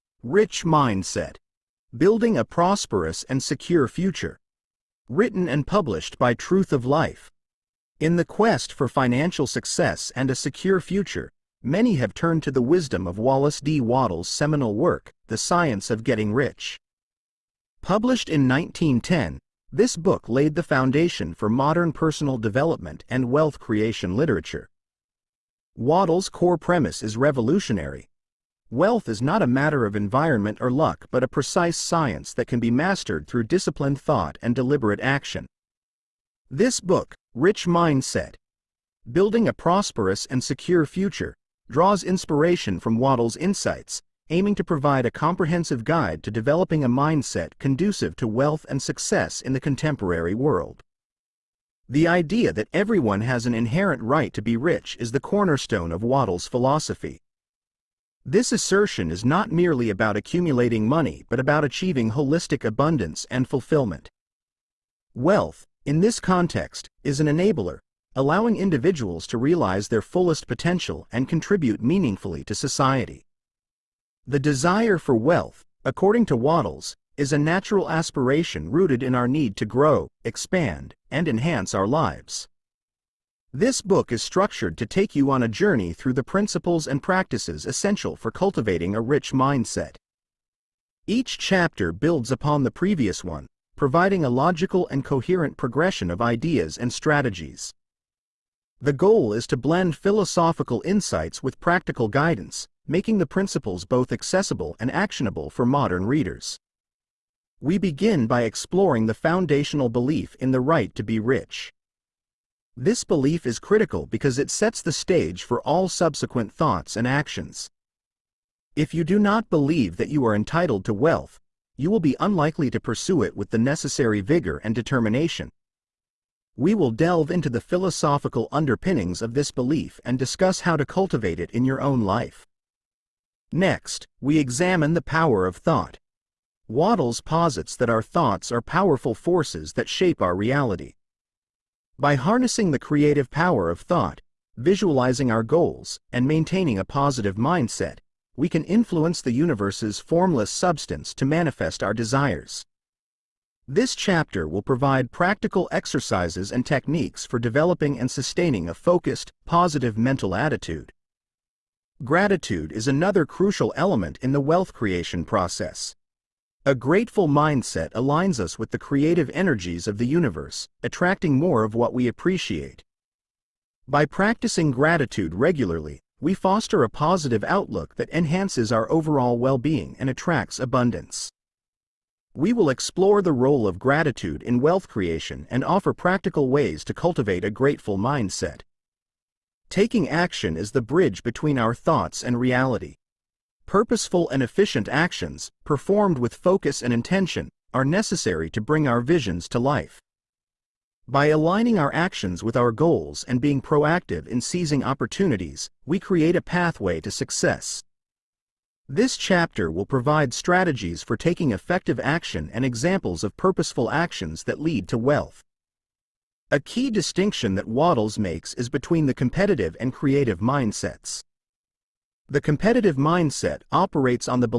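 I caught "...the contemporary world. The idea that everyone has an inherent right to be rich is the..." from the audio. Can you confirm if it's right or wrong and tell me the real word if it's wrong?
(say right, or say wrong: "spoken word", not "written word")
right.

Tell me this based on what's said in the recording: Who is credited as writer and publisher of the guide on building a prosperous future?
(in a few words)
Truth of Life.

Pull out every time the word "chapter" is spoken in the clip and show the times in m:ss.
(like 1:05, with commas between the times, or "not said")
1:31, 2:33, 3:29.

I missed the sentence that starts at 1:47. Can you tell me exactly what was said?
We begin by exploring the foundational belief in the right to be rich.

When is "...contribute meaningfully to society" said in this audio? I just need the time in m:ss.
1:11.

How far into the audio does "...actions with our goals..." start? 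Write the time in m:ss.
3:21.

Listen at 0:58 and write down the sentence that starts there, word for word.
This assertion is not merely about accumulating money but about achieving holistic abundance and fulfillment.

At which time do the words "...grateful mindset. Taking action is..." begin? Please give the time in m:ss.
3:07.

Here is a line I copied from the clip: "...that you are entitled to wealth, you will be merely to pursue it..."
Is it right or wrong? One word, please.
wrong.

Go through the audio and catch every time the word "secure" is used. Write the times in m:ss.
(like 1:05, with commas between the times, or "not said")
0:03, 0:10, 0:40.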